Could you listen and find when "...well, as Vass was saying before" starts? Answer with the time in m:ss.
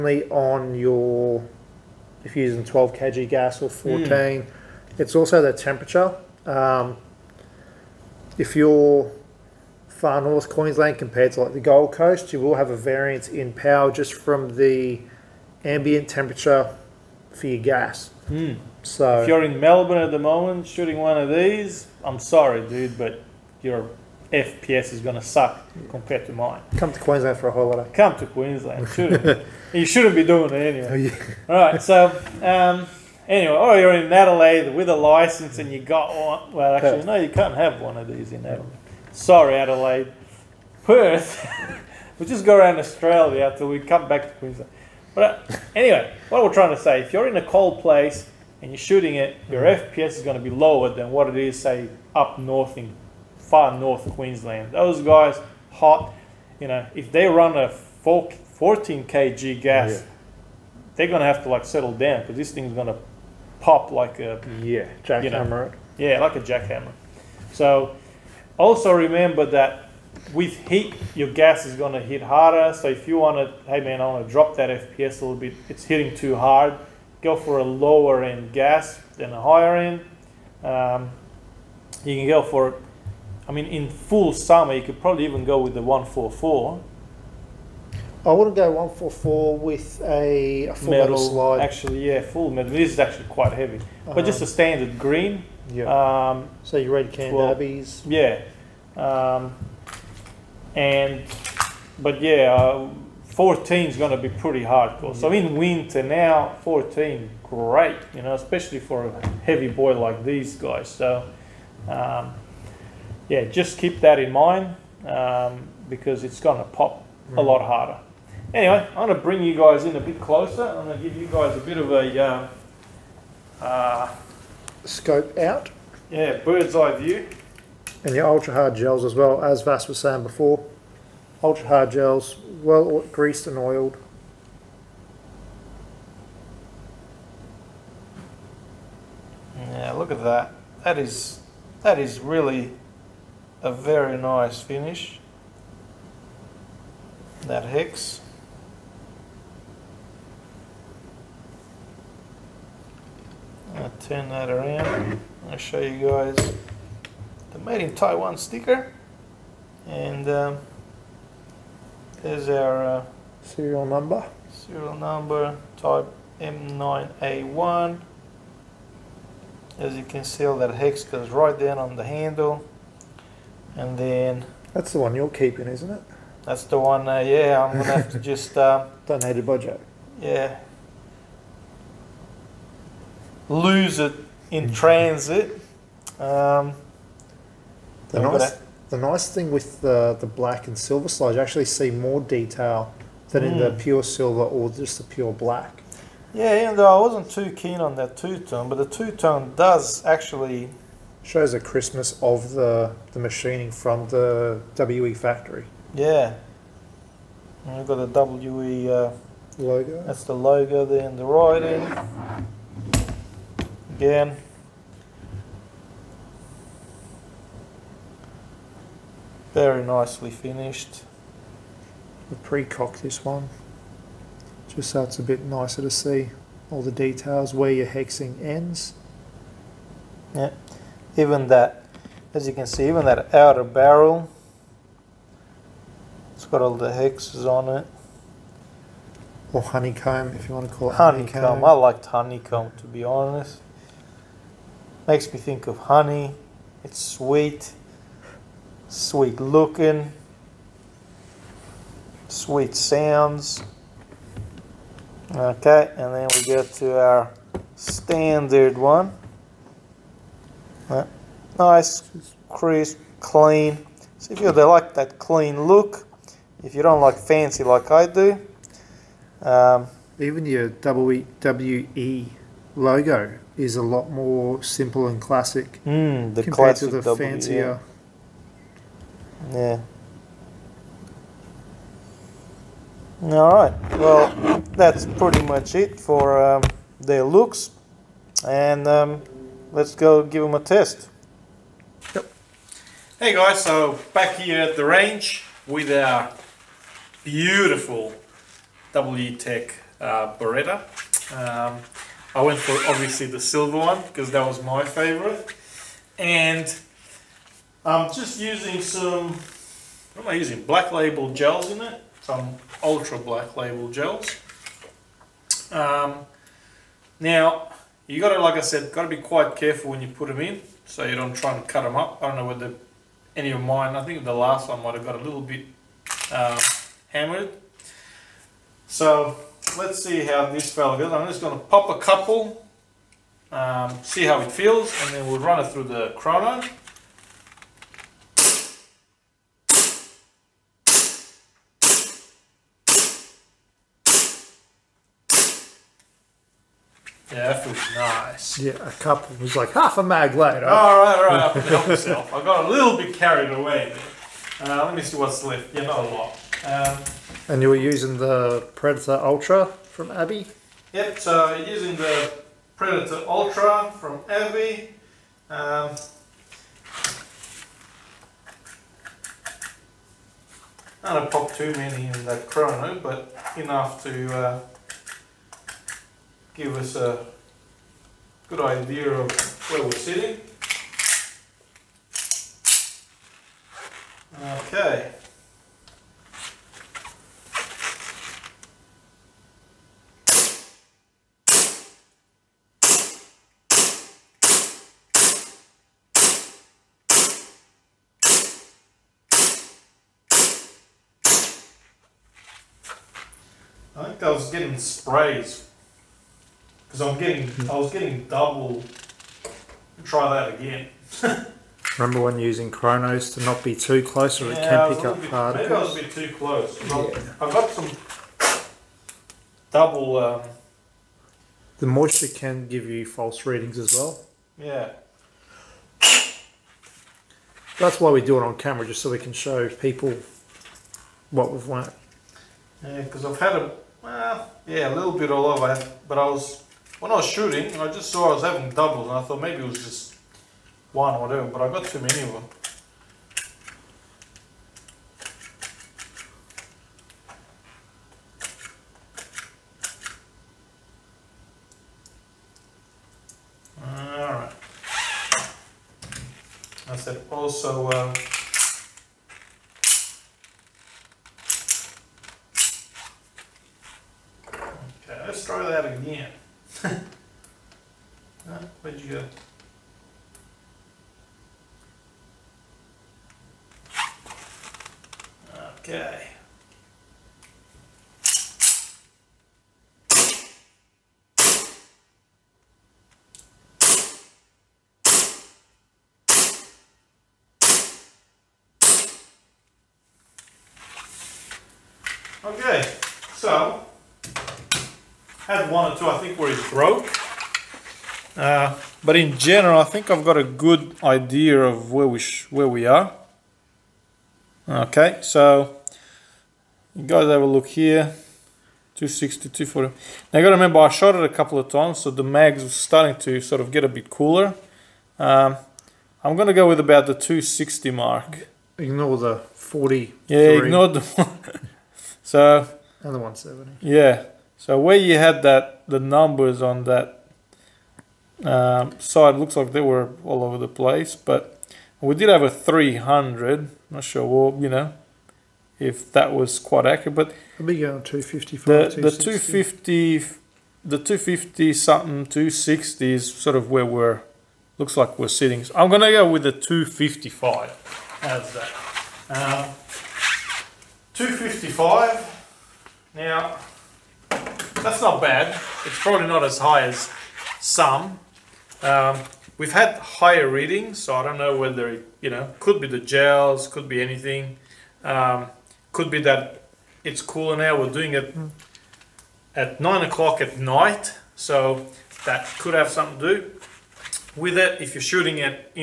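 2:09.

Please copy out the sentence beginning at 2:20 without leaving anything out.
That is that is really a very nice finish.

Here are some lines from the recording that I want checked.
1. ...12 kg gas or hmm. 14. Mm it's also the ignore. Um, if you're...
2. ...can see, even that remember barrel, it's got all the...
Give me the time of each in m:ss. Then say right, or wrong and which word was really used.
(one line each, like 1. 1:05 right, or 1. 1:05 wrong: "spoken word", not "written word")
1. 0:02 wrong: "temperature", not "ignore"
2. 3:52 wrong: "outer", not "remember".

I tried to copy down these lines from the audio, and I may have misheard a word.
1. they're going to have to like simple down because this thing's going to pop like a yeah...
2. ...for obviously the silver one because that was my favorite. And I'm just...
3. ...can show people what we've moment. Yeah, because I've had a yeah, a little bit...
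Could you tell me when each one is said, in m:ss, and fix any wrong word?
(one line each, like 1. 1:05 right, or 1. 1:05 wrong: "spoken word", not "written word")
1. 1:00 wrong: "settle", not "simple"
2. 5:02 right
3. 7:09 wrong: "learnt", not "moment".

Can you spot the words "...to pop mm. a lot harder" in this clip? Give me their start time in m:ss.
1:56.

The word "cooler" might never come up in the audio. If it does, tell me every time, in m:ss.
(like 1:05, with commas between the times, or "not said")
8:34, 9:27.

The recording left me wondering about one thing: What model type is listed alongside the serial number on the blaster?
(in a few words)
M9A1.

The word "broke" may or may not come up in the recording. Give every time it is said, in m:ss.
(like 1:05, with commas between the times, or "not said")
8:16.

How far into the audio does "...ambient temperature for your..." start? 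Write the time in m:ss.
0:15.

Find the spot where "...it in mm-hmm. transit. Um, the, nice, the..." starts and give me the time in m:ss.
3:03.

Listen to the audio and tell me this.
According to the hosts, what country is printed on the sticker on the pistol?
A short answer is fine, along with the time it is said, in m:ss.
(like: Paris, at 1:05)
Taiwan, at 2:37.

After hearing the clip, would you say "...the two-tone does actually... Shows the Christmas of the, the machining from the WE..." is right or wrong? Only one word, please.
right.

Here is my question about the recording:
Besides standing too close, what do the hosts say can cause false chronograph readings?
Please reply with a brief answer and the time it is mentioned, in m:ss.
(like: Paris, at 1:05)
Moisture, at 7:01.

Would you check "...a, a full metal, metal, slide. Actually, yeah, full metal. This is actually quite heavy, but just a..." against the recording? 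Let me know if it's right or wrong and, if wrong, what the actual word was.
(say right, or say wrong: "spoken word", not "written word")
right.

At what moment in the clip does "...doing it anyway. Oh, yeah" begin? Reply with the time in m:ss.
0:30.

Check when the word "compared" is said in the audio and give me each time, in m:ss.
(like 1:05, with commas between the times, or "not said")
0:10, 0:25, 4:36.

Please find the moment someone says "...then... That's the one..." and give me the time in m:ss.
2:53.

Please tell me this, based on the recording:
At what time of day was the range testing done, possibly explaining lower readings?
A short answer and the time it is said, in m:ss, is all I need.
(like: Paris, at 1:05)
9 o'clock at night, at 9:29.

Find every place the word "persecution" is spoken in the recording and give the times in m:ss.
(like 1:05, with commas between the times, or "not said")
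not said.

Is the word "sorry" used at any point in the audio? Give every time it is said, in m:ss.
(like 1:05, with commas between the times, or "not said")
0:22, 0:39.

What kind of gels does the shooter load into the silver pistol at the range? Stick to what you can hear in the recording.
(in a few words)
Ultra black label gels.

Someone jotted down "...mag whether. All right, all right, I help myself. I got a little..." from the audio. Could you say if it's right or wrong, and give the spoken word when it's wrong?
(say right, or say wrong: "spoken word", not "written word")
wrong: "later", not "whether".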